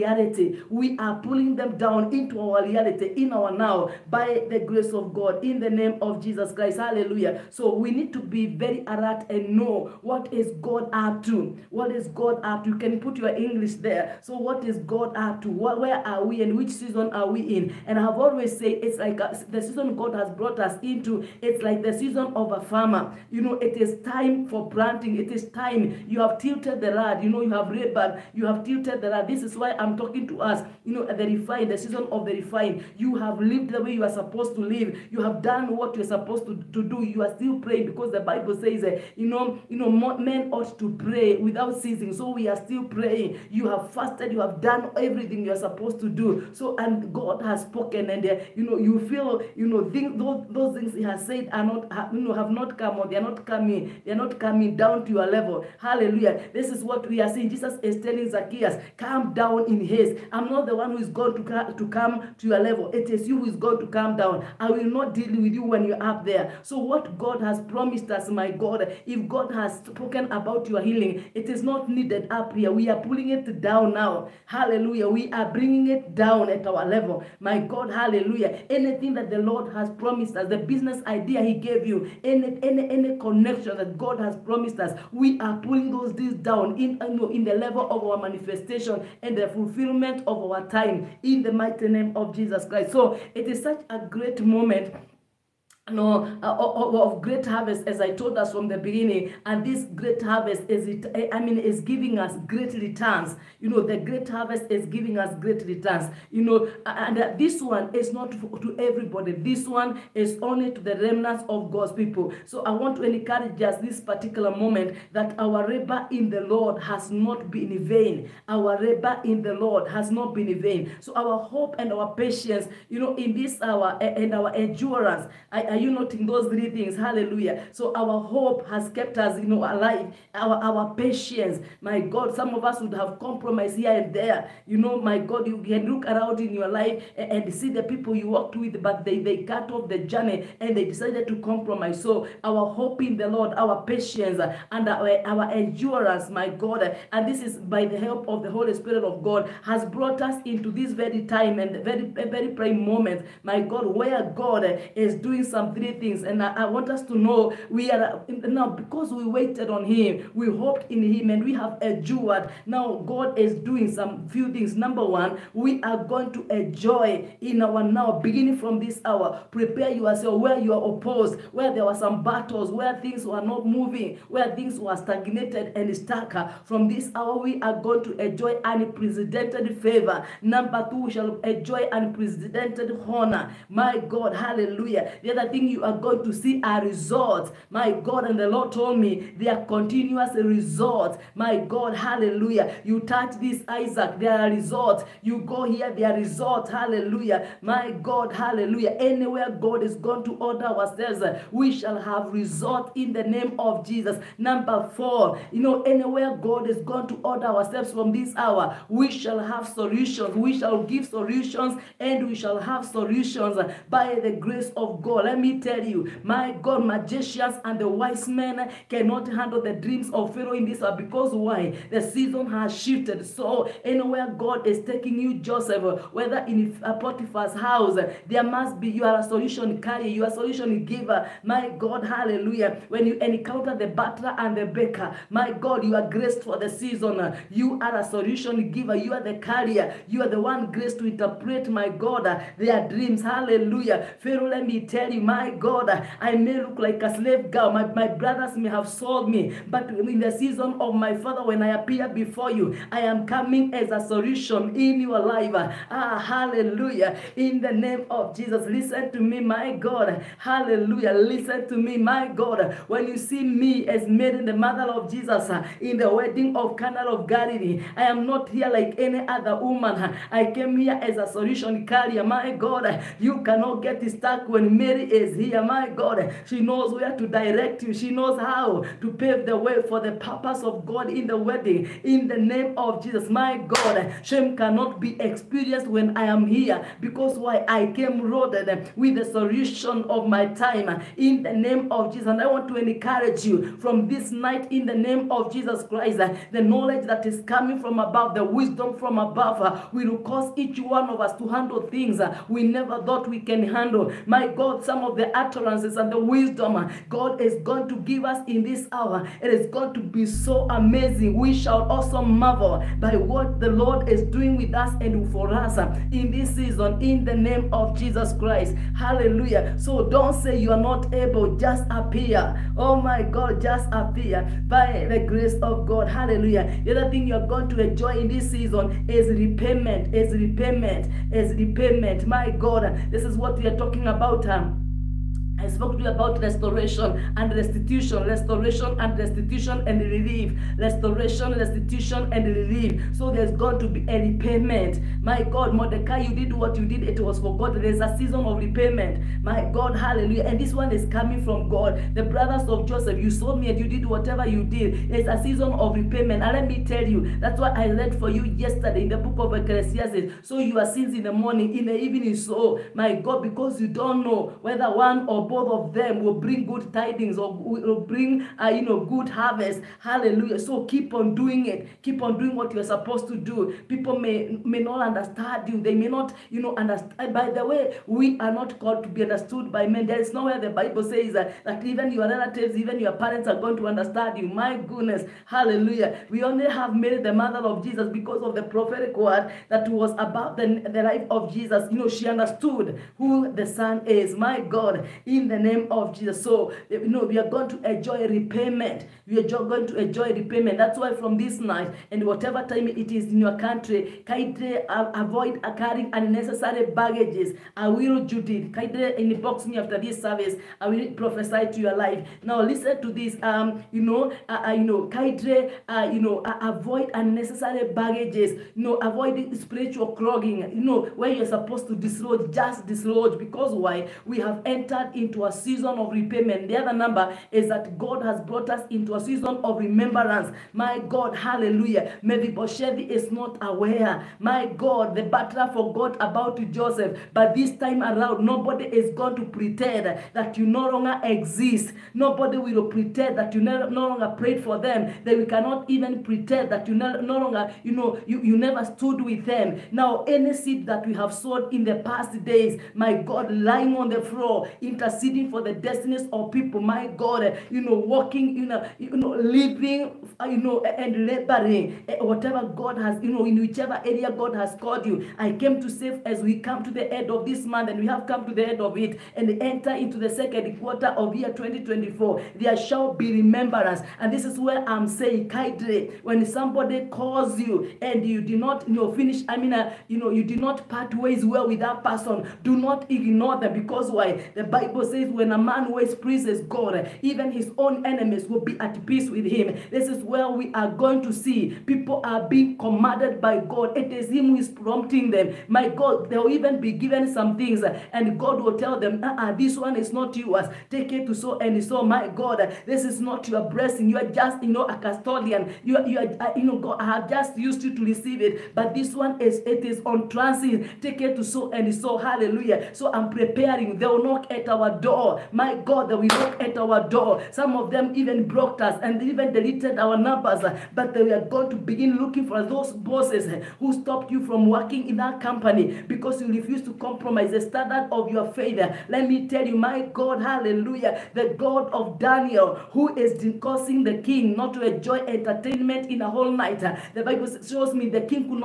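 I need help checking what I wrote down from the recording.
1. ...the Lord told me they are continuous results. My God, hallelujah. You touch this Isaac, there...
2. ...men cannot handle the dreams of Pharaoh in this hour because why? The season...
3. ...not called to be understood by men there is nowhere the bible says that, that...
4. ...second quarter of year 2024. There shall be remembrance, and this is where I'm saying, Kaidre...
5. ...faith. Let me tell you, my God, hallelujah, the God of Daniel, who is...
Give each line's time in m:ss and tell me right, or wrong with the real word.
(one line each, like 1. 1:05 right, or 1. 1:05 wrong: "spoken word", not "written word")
1. 3:08 right
2. 3:38 right
3. 6:18 right
4. 7:50 right
5. 8:48 right.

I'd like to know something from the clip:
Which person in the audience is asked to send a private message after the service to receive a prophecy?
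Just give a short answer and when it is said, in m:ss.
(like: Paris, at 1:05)
Judith, at 6:48.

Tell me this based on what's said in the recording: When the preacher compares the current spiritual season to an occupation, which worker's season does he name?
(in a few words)
A farmer.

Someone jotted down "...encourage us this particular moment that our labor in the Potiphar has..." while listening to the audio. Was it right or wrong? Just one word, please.
wrong.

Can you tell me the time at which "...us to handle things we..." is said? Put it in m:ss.
5:01.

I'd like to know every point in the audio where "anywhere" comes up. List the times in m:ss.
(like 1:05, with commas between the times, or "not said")
3:18, 3:25, 3:43.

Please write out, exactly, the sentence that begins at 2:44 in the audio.
Number one, we are going to enjoy in our now, beginning from this hour.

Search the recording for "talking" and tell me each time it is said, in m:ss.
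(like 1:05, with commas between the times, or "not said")
0:29, 5:33.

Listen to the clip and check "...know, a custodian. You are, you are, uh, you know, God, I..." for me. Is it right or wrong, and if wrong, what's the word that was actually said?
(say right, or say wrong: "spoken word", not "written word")
right.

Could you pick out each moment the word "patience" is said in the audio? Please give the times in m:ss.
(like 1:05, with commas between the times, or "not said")
2:02, 2:10, 2:23.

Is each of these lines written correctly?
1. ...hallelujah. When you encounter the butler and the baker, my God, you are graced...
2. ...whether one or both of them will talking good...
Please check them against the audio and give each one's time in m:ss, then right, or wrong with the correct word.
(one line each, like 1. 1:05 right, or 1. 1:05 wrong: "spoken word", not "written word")
1. 3:52 right
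2. 6:04 wrong: "bring", not "talking".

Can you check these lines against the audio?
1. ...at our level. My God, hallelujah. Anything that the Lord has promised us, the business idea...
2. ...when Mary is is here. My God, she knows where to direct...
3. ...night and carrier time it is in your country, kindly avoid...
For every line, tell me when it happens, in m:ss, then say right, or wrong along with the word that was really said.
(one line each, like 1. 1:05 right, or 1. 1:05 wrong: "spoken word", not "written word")
1. 1:16 right
2. 4:34 right
3. 6:41 wrong: "whatever", not "carrier".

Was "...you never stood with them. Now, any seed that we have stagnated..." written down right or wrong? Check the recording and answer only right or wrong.
wrong.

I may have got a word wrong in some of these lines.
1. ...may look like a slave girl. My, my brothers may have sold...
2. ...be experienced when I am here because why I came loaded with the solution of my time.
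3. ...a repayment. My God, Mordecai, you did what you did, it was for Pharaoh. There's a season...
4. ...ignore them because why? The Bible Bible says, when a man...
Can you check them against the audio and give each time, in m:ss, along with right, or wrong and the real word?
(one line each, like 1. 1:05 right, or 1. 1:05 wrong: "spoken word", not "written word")
1. 4:06 right
2. 4:44 right
3. 5:44 wrong: "God", not "Pharaoh"
4. 8:03 right.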